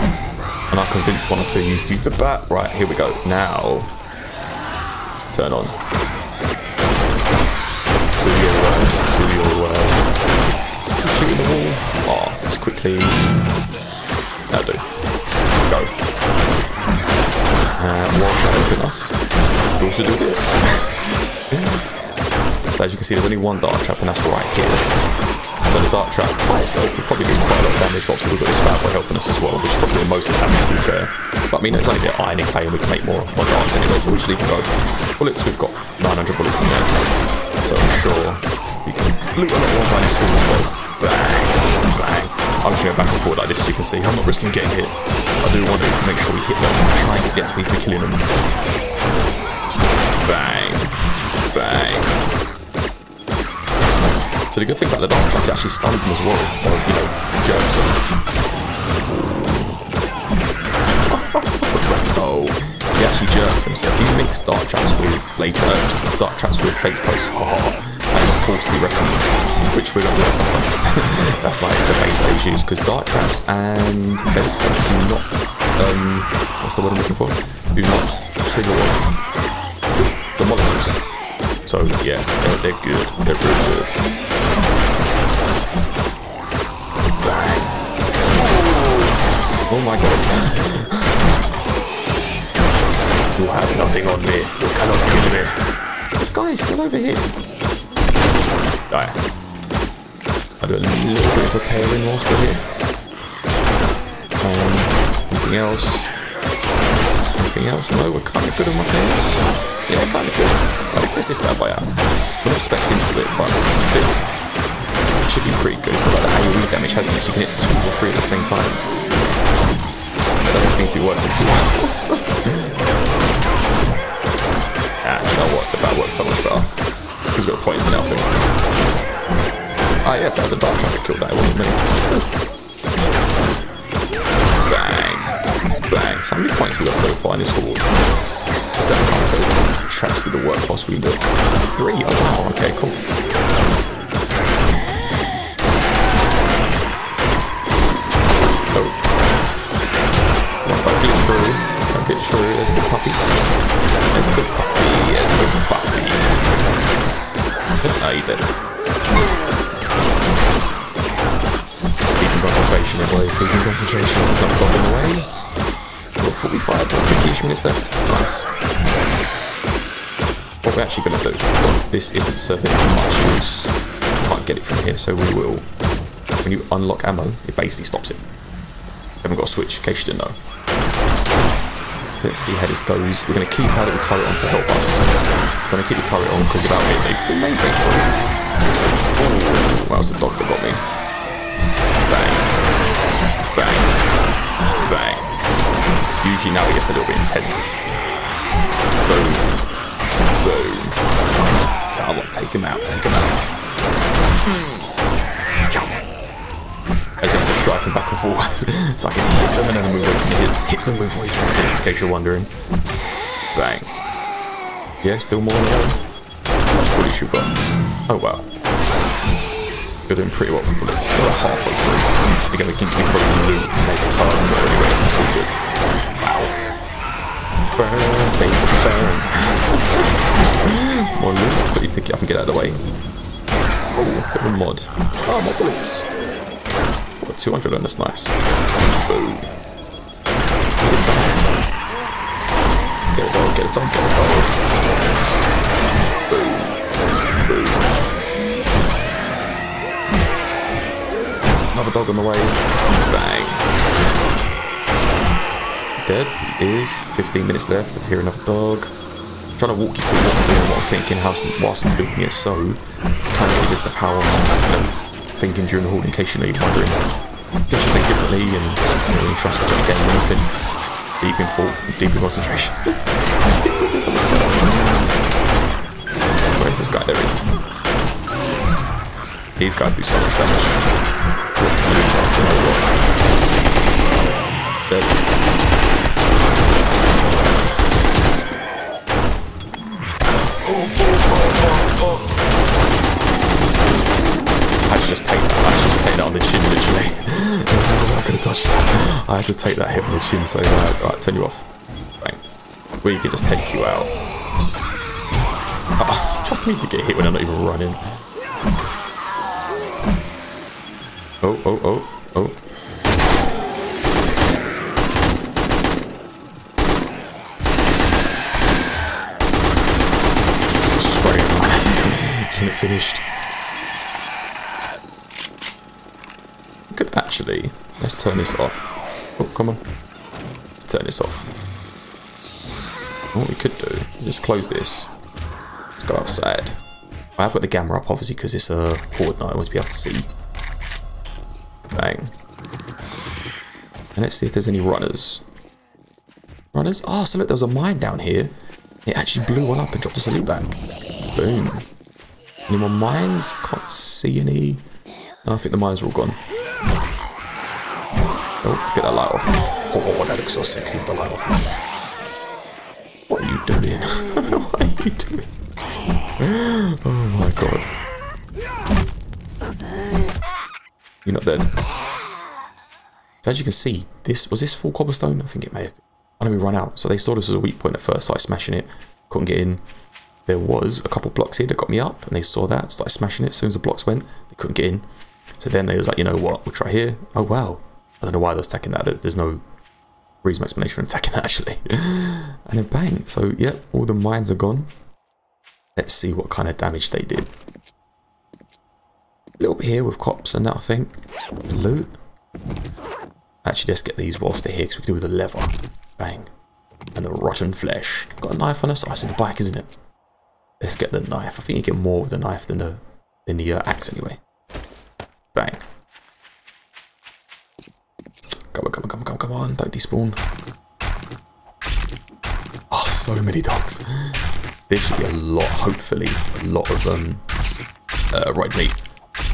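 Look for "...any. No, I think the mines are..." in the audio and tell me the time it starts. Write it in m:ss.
5:54.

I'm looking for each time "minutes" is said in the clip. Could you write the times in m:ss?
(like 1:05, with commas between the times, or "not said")
2:47, 4:17.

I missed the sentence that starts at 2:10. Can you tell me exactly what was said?
Ah, yes, that was a dart shot that killed that.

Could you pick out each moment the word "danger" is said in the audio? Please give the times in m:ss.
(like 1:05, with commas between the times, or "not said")
not said.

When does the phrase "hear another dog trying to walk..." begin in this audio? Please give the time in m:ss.
4:18.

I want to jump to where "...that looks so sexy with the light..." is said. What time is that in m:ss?
6:00.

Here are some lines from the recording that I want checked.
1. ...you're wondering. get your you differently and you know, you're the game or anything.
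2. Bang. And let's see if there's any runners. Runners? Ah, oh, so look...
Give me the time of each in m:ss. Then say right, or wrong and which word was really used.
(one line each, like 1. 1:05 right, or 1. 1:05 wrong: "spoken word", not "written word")
1. 4:26 right
2. 5:41 right.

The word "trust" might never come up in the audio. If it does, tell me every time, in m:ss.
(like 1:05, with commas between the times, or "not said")
5:06.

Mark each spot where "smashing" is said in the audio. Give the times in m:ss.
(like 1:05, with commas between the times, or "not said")
6:18, 6:23.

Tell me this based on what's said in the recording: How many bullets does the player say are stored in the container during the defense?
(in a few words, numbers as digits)
900.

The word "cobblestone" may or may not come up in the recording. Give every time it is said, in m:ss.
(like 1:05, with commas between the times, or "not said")
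6:14.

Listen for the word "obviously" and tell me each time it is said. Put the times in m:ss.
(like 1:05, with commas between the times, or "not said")
0:28, 5:38.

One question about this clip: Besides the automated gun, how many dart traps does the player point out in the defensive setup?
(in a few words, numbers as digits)
1.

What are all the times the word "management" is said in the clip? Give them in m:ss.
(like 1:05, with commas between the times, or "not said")
not said.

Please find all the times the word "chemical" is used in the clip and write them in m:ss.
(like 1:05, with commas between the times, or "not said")
not said.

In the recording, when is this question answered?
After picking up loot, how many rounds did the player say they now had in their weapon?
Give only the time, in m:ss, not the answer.
3:57.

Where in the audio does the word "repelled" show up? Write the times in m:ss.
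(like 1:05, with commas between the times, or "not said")
1:08.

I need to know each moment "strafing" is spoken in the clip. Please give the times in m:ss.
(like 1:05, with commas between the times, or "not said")
3:27.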